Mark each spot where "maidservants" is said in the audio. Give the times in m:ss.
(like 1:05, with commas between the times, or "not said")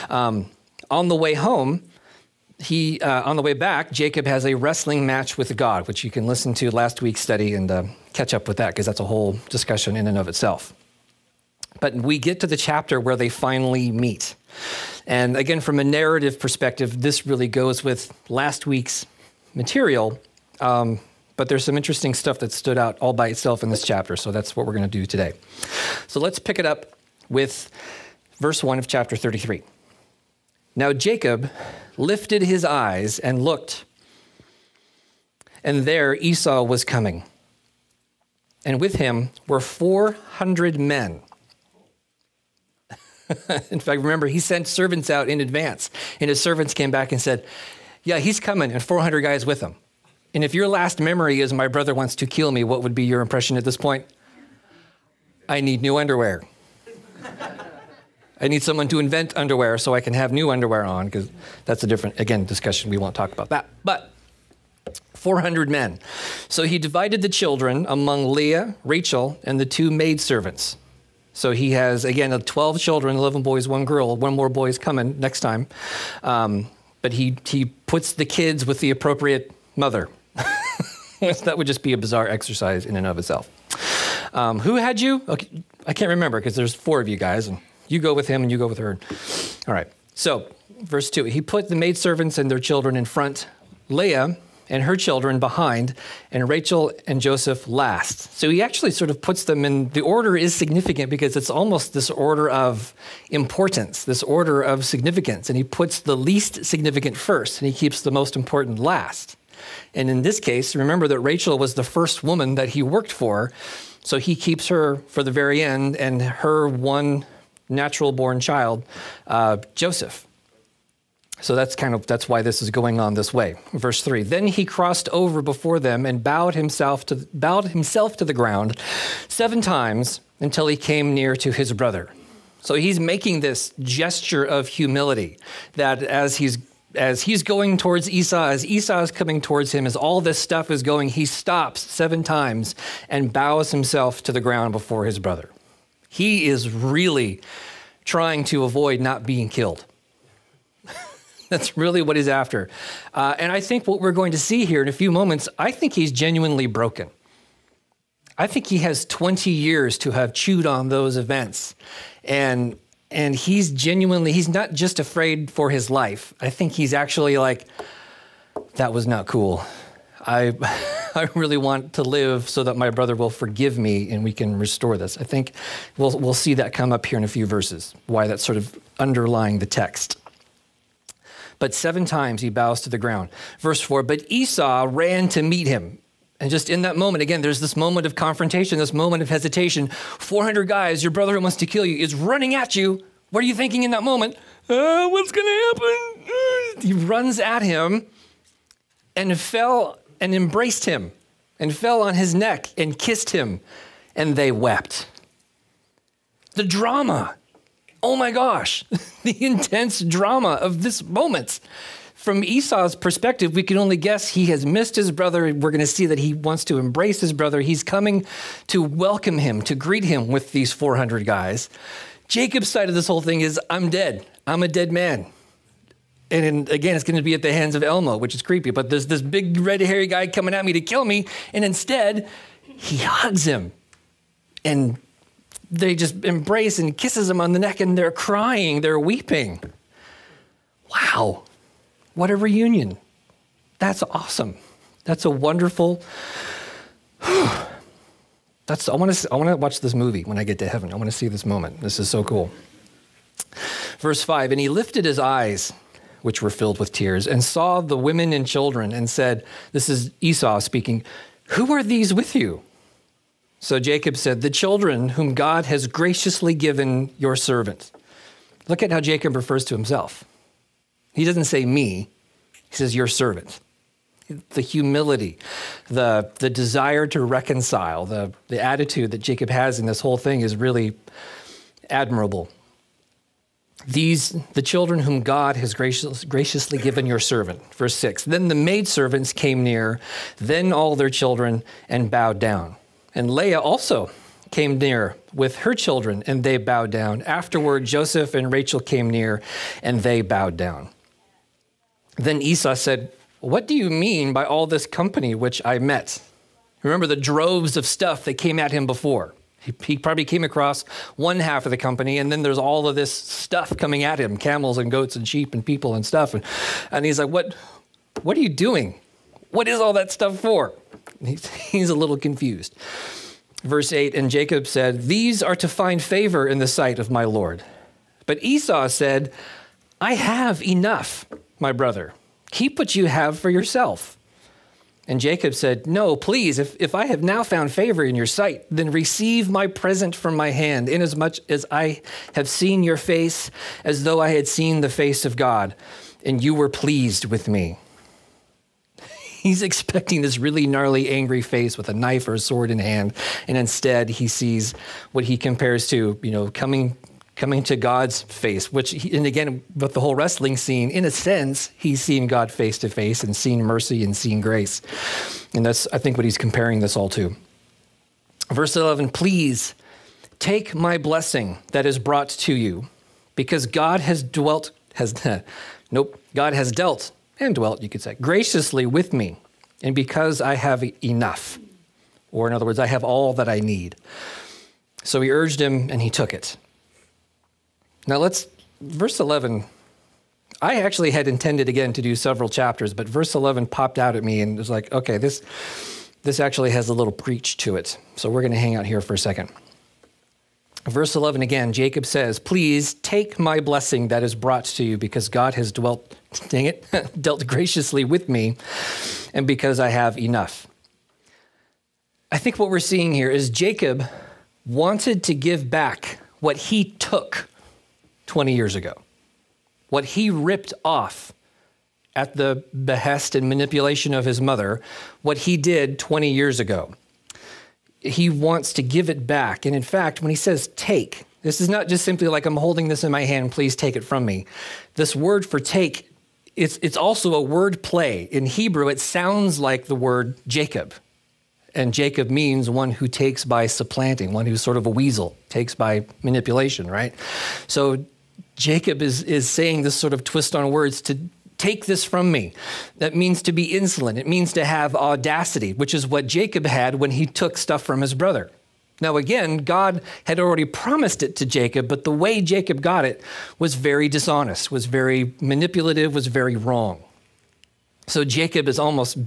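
1:09, 1:31, 4:48.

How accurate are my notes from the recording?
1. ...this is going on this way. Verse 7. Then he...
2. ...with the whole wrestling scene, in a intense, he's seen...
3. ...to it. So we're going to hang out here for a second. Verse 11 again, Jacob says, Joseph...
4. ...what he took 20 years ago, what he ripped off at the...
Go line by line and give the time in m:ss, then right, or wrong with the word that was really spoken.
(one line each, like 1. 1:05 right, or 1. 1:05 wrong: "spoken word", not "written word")
1. 2:02 wrong: "3", not "7"
2. 5:59 wrong: "sense", not "intense"
3. 6:37 wrong: "Please", not "Joseph"
4. 6:56 right.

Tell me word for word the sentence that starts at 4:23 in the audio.
So Jacob said, The children whom God has graciously given your servant.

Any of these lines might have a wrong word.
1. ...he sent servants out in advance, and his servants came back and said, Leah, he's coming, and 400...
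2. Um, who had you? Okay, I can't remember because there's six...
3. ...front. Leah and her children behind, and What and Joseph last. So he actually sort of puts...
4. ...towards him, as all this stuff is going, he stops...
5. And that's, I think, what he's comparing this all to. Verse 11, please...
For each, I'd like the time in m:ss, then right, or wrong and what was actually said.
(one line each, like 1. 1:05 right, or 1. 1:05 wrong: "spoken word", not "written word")
1. 0:44 wrong: "Yeah", not "Leah"
2. 1:24 wrong: "four", not "six"
3. 1:33 wrong: "Rachel", not "What"
4. 2:19 right
5. 6:05 right.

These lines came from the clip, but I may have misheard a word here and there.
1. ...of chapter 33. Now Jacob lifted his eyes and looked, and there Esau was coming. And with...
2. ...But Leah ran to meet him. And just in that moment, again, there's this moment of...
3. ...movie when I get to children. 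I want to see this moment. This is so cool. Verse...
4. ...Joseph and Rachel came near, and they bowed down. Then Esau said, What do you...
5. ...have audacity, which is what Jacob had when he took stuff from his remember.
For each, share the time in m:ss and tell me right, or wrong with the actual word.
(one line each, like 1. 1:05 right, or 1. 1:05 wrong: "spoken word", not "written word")
1. 0:28 right
2. 3:04 wrong: "Esau", not "Leah"
3. 4:09 wrong: "heaven", not "children"
4. 4:57 right
5. 7:34 wrong: "brother", not "remember".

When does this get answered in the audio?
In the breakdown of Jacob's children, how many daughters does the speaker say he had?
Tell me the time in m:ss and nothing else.
1:13.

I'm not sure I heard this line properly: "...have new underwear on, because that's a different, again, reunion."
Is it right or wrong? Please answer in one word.
wrong.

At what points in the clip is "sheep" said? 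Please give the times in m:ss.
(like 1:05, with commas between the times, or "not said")
5:15.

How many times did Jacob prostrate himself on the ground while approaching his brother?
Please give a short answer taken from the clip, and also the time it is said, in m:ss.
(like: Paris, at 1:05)
7, at 2:09.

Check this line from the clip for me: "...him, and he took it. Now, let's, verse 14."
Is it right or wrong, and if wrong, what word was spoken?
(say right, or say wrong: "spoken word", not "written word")
wrong: "11", not "14".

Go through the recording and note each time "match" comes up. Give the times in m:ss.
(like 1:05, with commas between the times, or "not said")
0:05.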